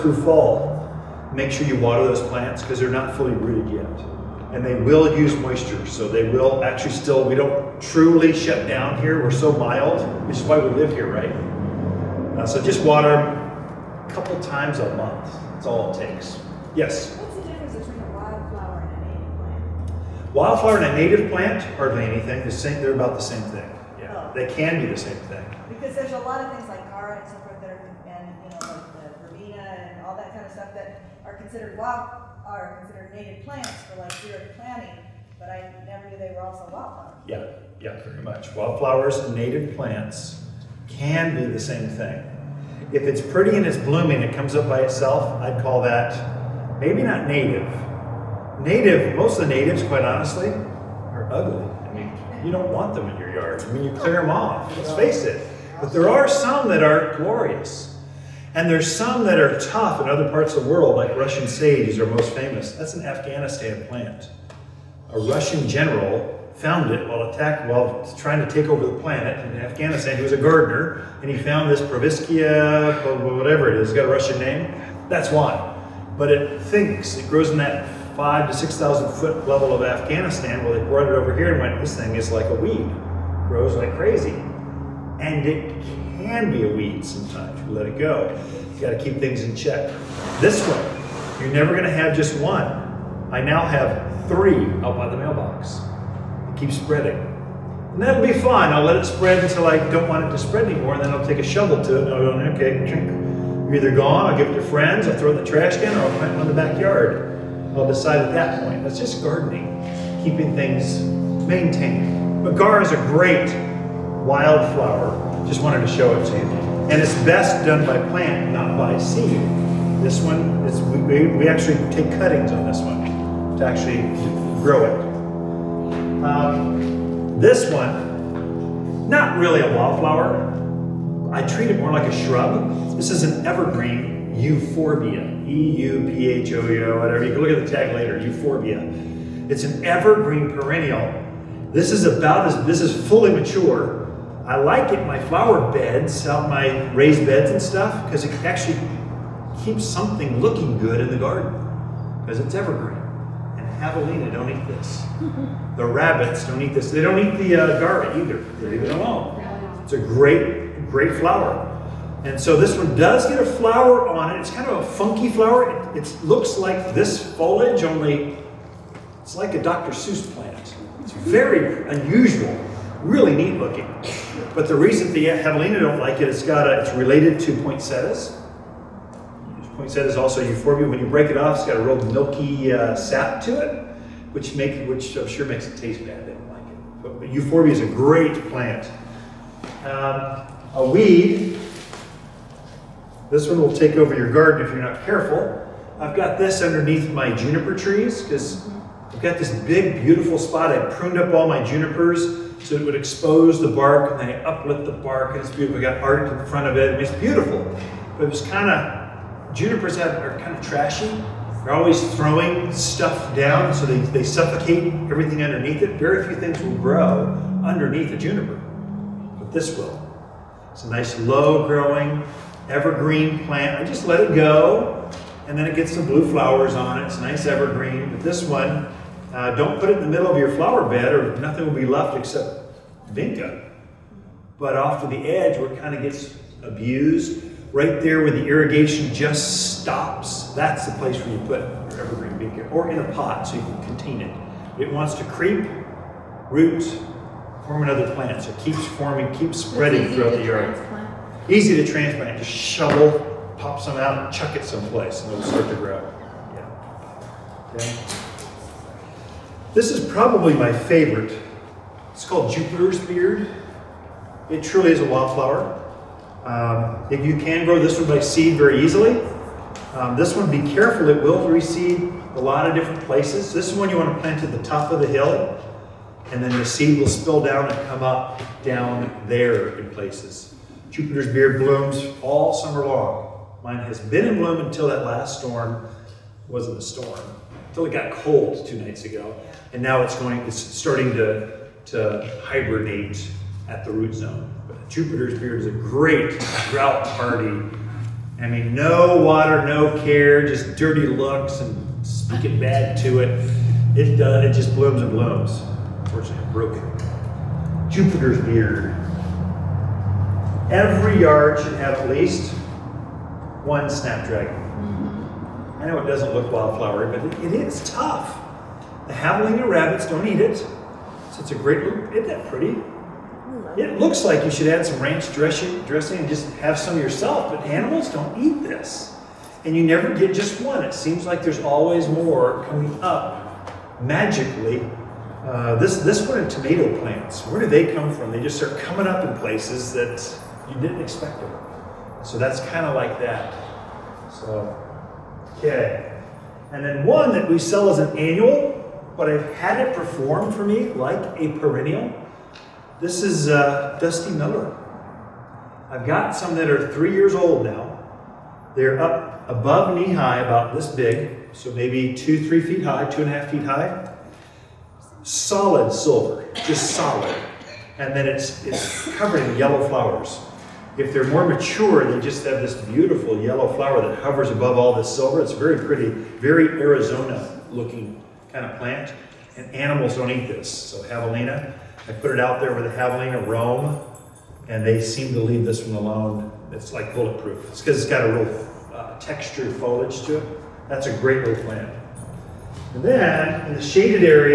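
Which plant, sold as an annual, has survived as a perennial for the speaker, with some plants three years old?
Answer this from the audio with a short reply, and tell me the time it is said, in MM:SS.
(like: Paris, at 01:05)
Dusty Miller, at 05:53.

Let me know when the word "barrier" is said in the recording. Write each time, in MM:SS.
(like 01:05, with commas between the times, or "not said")
not said.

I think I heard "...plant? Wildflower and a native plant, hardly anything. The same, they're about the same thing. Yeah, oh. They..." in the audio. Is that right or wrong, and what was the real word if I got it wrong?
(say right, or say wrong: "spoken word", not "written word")
right.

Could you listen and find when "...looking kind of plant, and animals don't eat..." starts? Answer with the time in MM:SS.
06:17.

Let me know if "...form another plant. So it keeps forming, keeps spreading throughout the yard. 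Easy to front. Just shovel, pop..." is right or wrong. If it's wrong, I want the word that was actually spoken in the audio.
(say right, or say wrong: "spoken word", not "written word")
wrong: "transplant", not "front".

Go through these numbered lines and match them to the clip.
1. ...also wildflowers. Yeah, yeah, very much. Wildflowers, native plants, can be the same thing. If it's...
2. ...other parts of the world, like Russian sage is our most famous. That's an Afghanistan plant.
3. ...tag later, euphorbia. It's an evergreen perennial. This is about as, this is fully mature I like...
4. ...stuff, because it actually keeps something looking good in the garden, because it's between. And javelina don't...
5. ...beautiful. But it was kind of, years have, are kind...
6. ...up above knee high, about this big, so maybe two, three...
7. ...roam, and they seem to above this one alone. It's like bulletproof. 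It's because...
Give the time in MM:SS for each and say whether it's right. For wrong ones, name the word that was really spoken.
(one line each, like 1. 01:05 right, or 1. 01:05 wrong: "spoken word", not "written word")
1. 00:36 right
2. 01:00 right
3. 02:17 right
4. 02:27 wrong: "evergreen", not "between"
5. 03:27 wrong: "junipers", not "years"
6. 05:58 right
7. 06:23 wrong: "leave", not "above".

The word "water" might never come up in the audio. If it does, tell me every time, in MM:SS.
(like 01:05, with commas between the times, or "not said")
00:01, 00:12, 04:59.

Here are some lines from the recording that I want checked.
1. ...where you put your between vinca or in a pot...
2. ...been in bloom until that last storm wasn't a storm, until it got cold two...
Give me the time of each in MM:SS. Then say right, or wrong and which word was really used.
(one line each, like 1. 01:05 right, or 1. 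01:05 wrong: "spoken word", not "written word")
1. 04:01 wrong: "evergreen", not "between"
2. 04:43 right.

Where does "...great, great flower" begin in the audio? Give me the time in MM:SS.
02:39.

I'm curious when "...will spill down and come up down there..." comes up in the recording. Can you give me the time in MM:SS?
04:36.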